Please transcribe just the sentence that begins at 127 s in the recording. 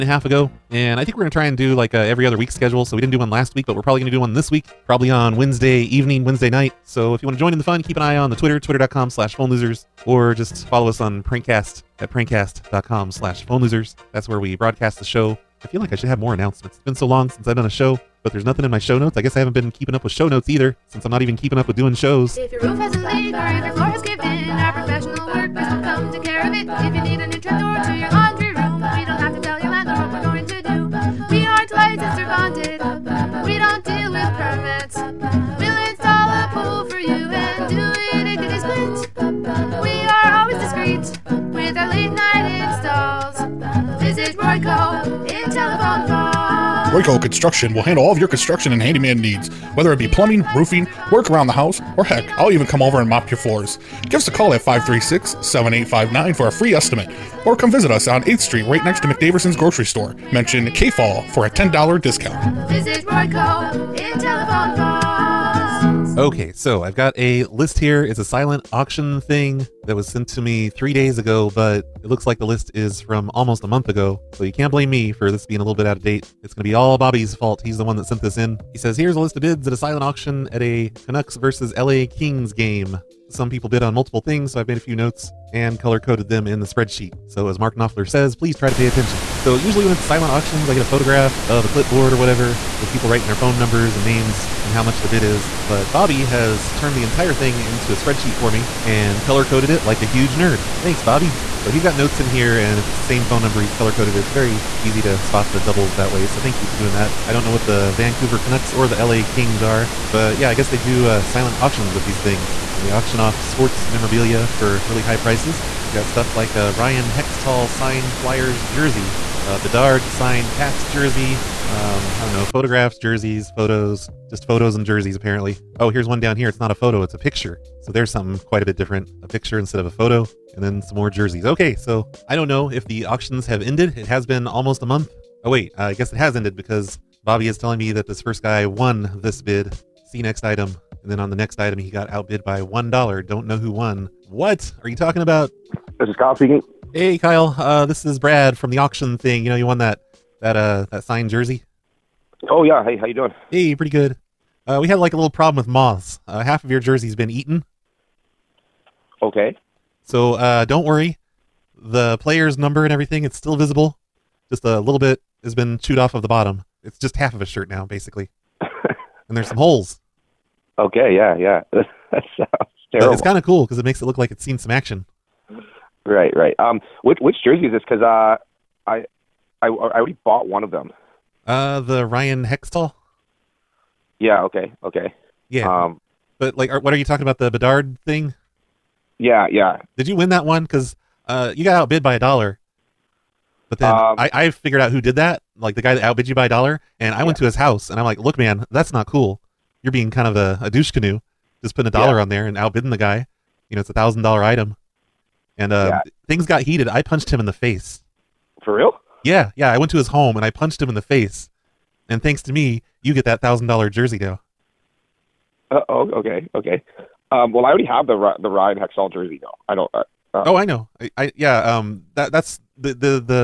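So there's something quite a bit different.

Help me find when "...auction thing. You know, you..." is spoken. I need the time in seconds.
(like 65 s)
148 s.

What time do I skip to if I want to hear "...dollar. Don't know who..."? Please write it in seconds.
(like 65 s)
142 s.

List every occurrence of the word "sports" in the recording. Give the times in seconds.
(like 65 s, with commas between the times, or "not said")
113 s.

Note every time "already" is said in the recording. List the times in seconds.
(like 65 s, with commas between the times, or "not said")
179 s, 217 s.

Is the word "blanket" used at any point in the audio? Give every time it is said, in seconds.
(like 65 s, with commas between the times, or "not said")
not said.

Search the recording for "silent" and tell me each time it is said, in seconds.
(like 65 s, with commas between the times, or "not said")
68 s, 79 s, 90 s, 111 s.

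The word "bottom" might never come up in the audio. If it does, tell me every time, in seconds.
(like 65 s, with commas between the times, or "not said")
166 s.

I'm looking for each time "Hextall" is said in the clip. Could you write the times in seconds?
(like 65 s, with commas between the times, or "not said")
117 s, 182 s.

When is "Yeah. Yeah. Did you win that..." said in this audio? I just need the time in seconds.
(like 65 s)
189 s.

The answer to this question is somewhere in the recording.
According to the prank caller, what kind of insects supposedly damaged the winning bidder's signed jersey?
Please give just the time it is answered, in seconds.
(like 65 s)
155 s.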